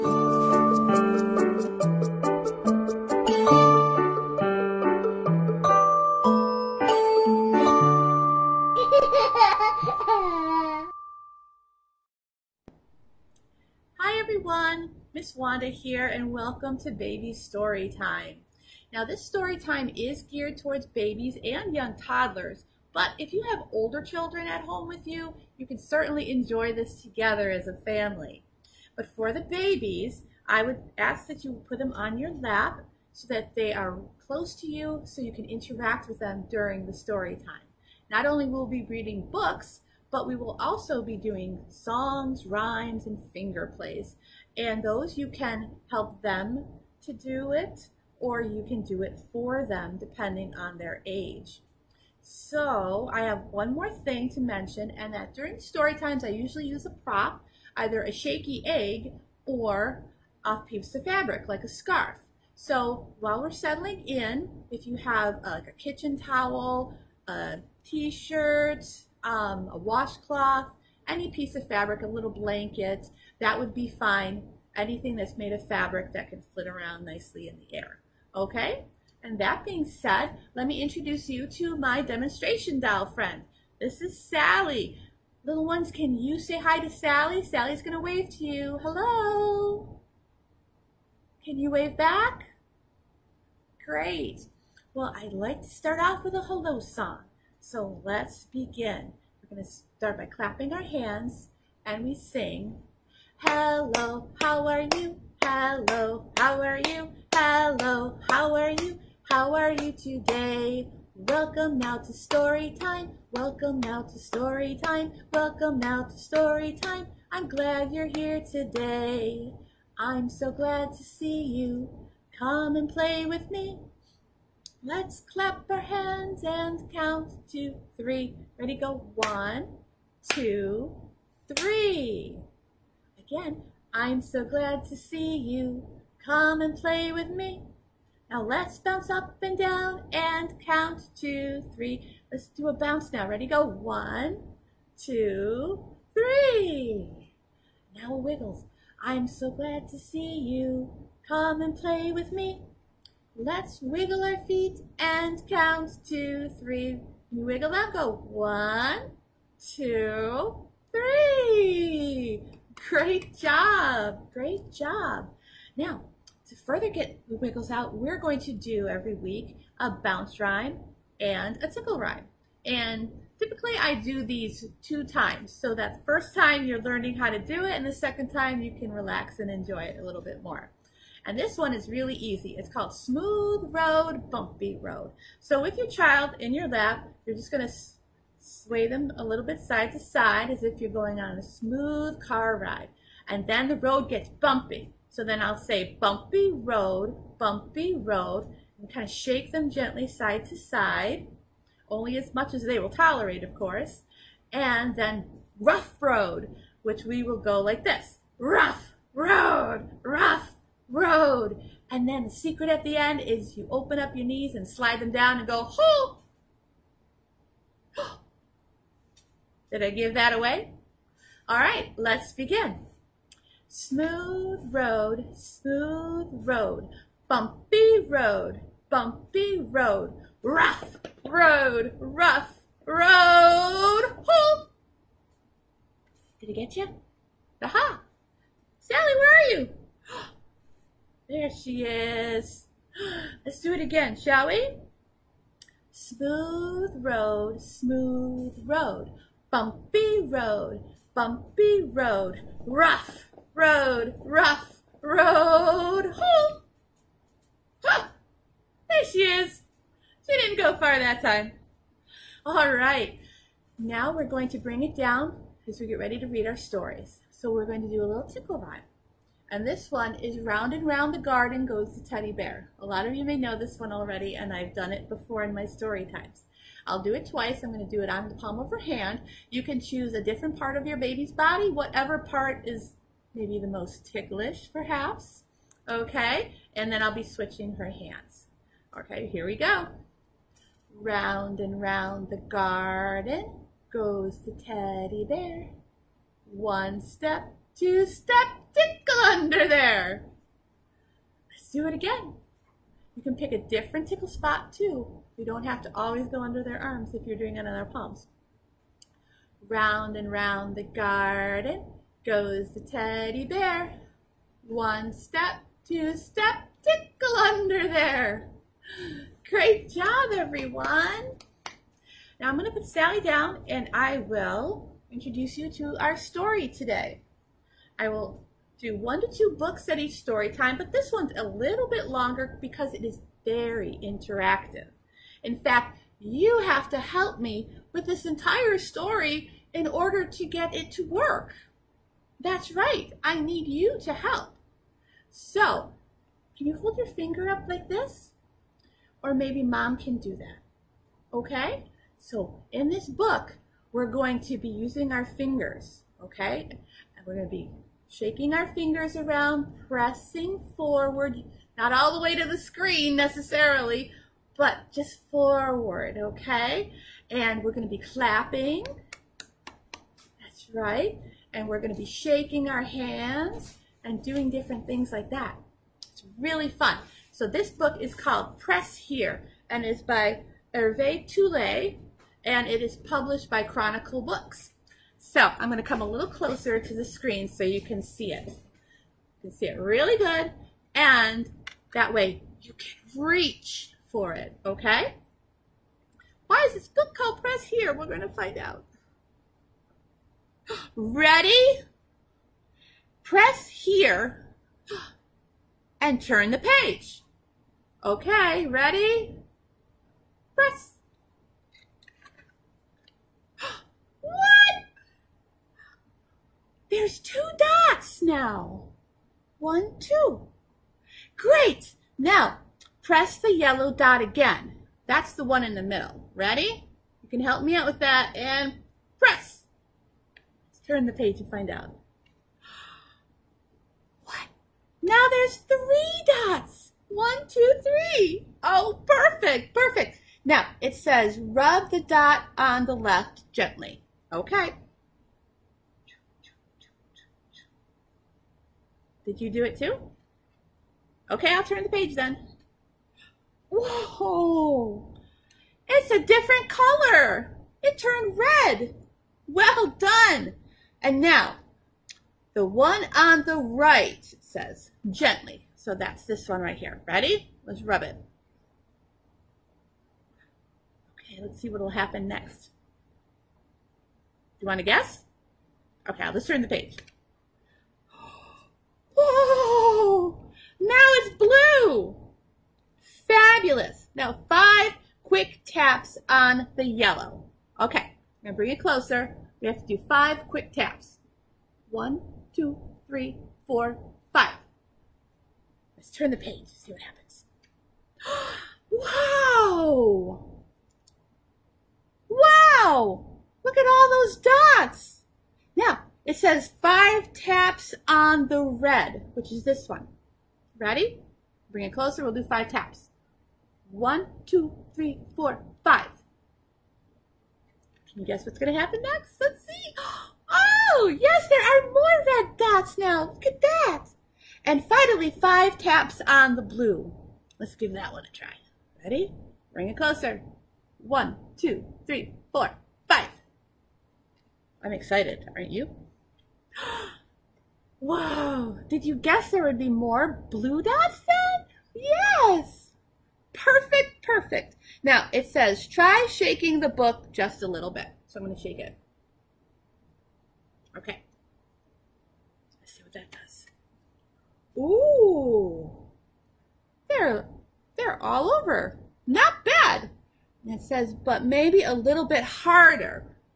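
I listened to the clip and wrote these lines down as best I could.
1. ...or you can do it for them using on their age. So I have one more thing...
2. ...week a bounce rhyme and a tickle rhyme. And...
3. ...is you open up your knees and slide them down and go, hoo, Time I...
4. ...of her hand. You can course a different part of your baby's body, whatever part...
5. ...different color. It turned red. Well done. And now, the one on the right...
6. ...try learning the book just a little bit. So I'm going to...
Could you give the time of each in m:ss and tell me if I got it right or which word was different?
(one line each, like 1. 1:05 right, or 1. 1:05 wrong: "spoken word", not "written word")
1. 0:48 wrong: "depending", not "using"
2. 2:49 right
3. 3:33 wrong: "Did", not "Time"
4. 4:38 wrong: "choose", not "course"
5. 7:36 right
6. 9:05 wrong: "shaking", not "learning".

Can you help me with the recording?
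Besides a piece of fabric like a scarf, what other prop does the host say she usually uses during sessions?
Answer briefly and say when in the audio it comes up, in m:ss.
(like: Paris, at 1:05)
shaky egg, at 0:58.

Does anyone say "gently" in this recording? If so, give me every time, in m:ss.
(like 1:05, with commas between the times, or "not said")
3:19, 7:23, 7:45.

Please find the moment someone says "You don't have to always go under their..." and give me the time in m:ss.
5:05.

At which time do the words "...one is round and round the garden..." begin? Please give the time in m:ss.
4:29.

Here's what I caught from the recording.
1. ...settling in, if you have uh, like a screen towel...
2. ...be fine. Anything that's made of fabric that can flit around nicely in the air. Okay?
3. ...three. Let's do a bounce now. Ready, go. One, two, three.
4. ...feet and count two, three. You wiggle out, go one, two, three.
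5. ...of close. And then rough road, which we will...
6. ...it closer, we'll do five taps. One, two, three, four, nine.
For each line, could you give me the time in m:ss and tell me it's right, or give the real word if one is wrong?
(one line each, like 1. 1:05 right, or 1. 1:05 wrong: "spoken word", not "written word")
1. 1:03 wrong: "kitchen", not "screen"
2. 1:13 right
3. 2:21 right
4. 2:34 right
5. 3:23 wrong: "course", not "close"
6. 8:31 wrong: "five", not "nine".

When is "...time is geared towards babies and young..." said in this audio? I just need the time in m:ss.
0:19.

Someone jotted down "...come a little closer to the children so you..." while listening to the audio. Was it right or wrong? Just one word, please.
wrong.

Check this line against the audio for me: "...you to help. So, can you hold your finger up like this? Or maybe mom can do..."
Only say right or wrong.
right.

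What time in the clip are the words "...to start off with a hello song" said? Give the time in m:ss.
1:35.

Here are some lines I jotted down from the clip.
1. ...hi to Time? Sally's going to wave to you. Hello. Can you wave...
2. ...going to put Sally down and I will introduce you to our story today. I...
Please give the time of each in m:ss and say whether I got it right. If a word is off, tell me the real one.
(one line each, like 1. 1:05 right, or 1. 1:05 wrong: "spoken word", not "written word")
1. 1:26 wrong: "Sally", not "Time"
2. 5:22 right.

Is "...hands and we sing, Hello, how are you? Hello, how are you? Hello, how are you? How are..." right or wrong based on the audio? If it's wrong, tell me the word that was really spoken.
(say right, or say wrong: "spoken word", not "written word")
right.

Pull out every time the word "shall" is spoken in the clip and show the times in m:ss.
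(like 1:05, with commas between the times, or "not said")
4:04.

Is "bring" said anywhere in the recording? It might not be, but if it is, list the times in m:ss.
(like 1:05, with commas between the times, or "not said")
4:24, 8:08, 8:31, 8:49.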